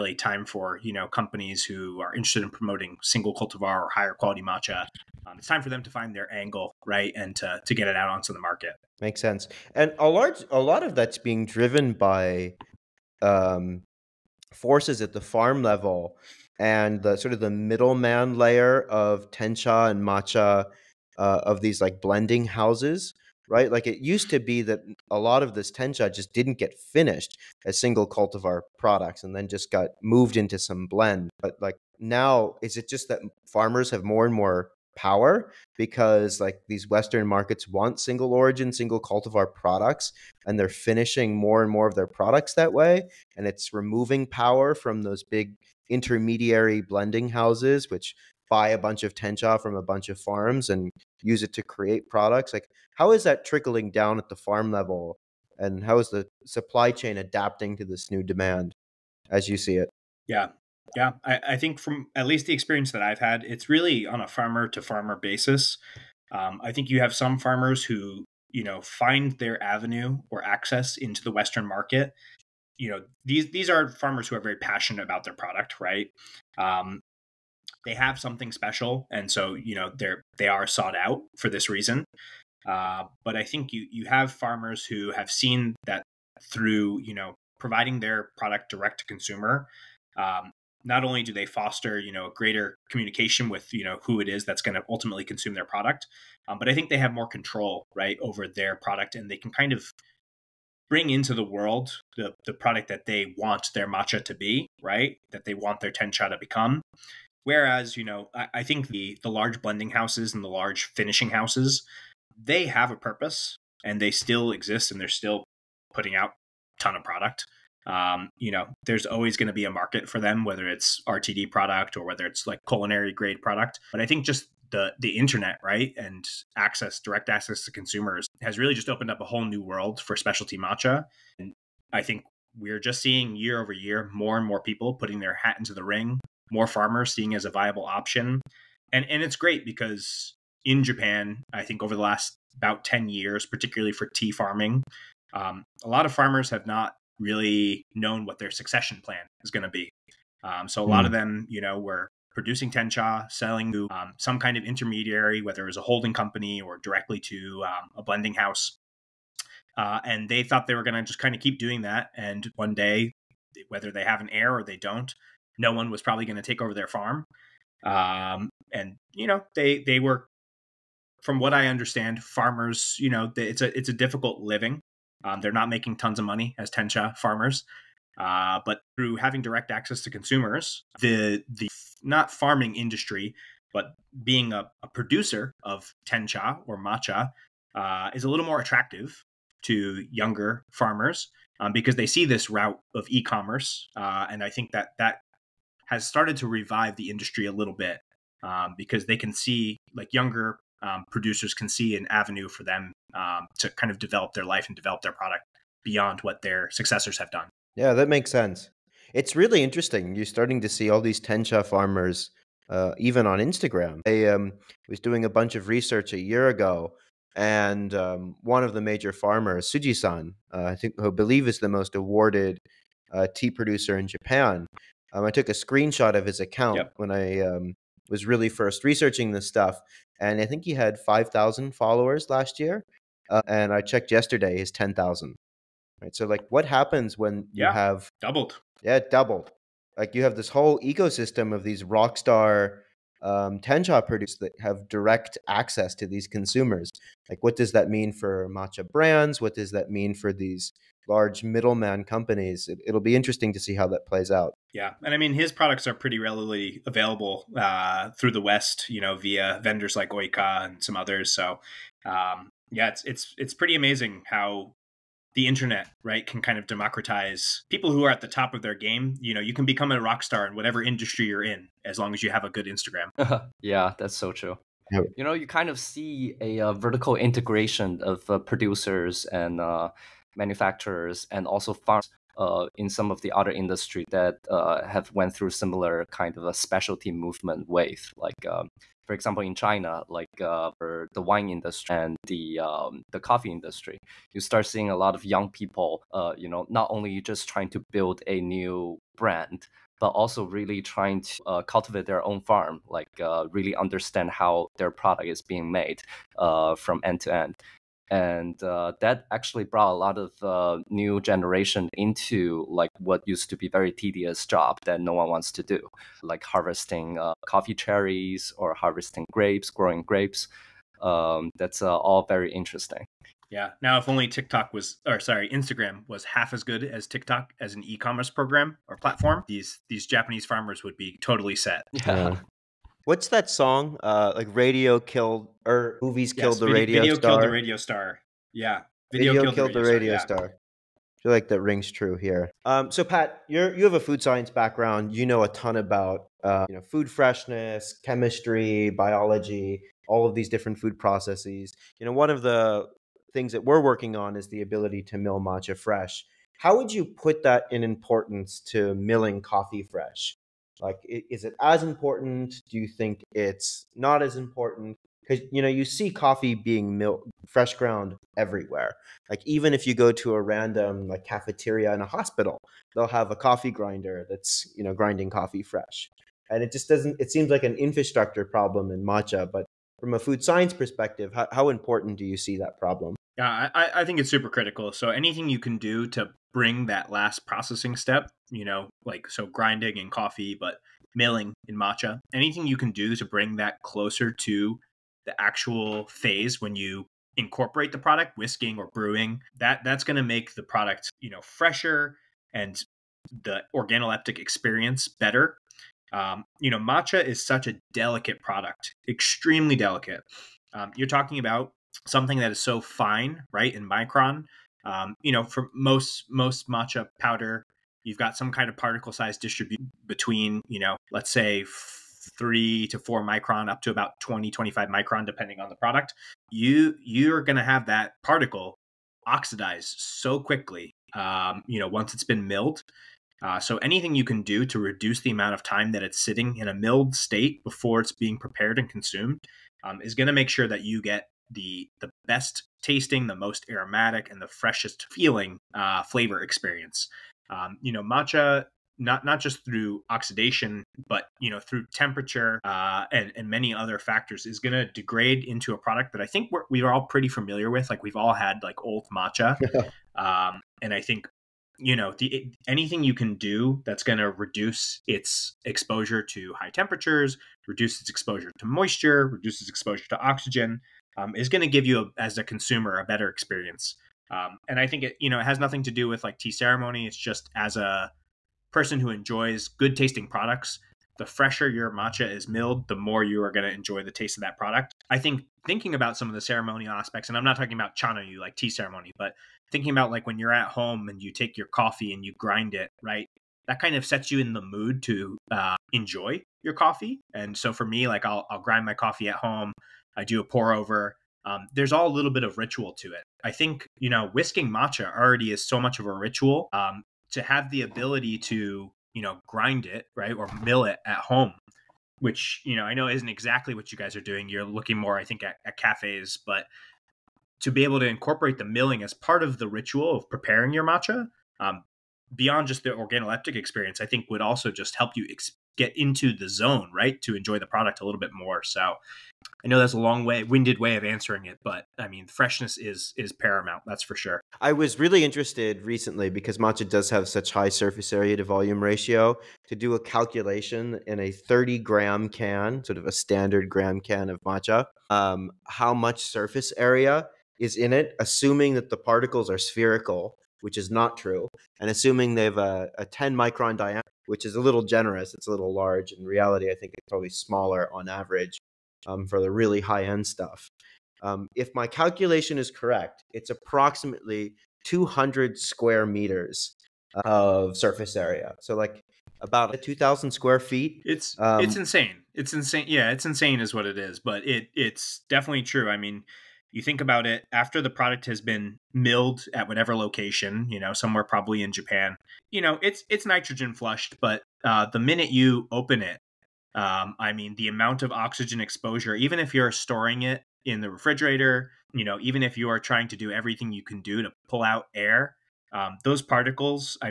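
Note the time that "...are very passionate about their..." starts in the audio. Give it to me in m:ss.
1:14.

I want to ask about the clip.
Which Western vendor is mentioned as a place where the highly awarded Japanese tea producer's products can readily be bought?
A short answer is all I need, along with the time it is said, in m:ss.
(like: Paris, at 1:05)
Ooika, at 4:20.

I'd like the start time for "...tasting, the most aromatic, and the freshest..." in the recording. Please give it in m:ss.
7:22.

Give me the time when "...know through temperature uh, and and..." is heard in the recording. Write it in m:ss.
7:31.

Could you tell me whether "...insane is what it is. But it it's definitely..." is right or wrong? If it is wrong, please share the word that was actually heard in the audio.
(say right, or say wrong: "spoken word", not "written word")
right.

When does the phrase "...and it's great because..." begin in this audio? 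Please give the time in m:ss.
2:19.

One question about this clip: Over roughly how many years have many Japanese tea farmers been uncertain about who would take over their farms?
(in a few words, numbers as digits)
10 years.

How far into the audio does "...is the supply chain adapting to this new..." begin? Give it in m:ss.
0:55.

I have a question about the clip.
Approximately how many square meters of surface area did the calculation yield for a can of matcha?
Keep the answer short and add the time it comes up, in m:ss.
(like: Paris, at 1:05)
200 square meters, at 9:24.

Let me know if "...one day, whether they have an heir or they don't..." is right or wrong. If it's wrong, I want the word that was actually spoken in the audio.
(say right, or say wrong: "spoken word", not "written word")
right.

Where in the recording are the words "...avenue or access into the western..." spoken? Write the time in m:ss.
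1:09.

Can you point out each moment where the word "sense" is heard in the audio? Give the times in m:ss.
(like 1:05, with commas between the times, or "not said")
0:09, 3:28.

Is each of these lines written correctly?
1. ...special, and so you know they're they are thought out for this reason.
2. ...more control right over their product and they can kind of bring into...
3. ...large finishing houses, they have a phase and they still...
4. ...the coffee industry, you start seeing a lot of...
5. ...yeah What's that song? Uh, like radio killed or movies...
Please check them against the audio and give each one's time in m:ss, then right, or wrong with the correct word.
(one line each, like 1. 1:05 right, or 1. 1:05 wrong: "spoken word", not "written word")
1. 1:18 wrong: "sought", not "thought"
2. 1:37 right
3. 1:50 wrong: "purpose", not "phase"
4. 4:53 right
5. 5:31 right.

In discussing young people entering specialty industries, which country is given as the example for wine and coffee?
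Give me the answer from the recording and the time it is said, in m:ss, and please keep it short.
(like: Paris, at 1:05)
China, at 4:49.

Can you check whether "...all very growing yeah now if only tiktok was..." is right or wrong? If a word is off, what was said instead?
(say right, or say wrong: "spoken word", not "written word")
wrong: "interesting", not "growing".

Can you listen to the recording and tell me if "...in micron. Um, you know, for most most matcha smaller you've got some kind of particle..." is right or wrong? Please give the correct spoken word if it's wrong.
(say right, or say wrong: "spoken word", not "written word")
wrong: "powder", not "smaller".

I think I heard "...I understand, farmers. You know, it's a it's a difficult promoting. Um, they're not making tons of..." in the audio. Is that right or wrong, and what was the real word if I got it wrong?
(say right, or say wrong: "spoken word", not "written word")
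wrong: "living", not "promoting".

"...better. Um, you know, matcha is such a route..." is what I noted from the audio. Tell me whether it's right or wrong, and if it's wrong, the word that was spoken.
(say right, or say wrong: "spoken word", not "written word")
wrong: "delicate", not "route".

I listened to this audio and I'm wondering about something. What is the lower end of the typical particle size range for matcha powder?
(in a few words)
3 to 4 microns.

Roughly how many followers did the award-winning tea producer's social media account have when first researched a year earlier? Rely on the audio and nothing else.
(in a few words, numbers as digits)
5,000.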